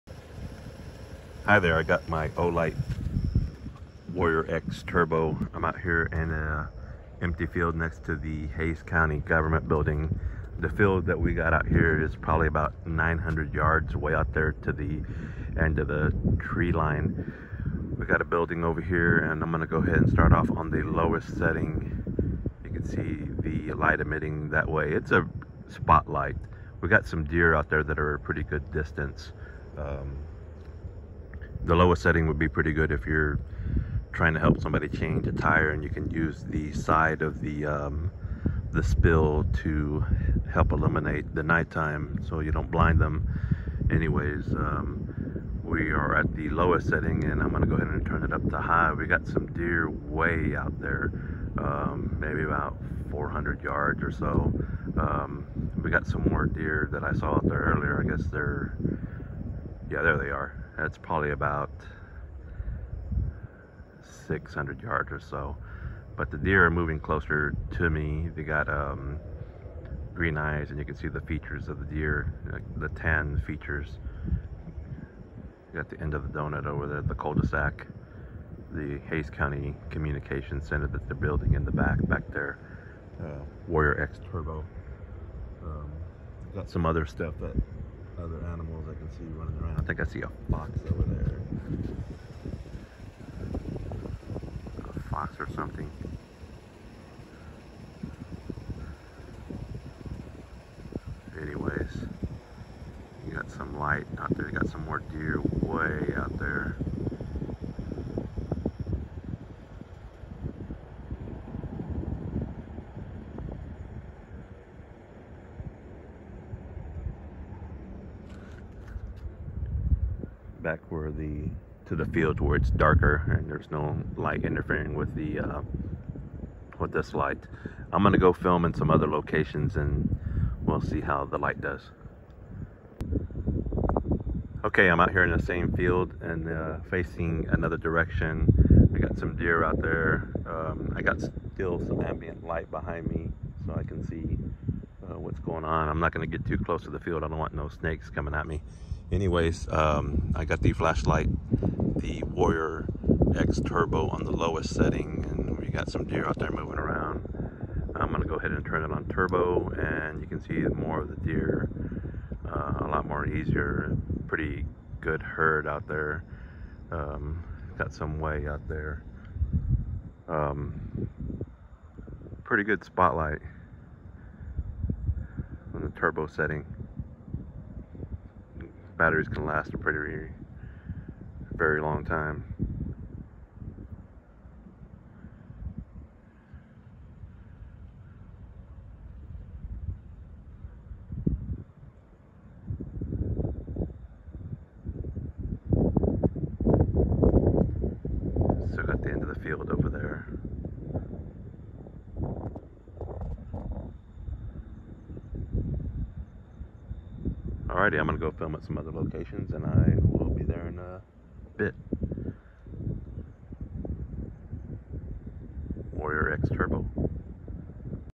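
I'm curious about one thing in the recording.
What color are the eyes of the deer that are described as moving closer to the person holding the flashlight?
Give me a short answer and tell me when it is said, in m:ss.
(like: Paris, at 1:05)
green, at 1:10.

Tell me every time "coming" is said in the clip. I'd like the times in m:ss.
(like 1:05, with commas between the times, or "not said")
2:28.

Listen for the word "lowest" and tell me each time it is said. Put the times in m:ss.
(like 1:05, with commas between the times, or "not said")
0:20, 0:31, 0:46, 2:34.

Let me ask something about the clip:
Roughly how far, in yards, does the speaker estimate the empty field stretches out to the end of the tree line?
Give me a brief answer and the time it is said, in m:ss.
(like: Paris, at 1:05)
900 yards, at 0:12.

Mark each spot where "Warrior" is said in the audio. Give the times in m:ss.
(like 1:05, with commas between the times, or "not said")
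0:04, 1:23, 2:32.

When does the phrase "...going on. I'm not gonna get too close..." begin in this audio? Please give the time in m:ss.
2:25.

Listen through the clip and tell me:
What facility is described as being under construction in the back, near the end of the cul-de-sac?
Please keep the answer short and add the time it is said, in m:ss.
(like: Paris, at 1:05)
Hays County Communication Center, at 1:19.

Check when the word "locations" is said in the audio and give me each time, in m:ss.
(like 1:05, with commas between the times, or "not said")
2:09, 3:28.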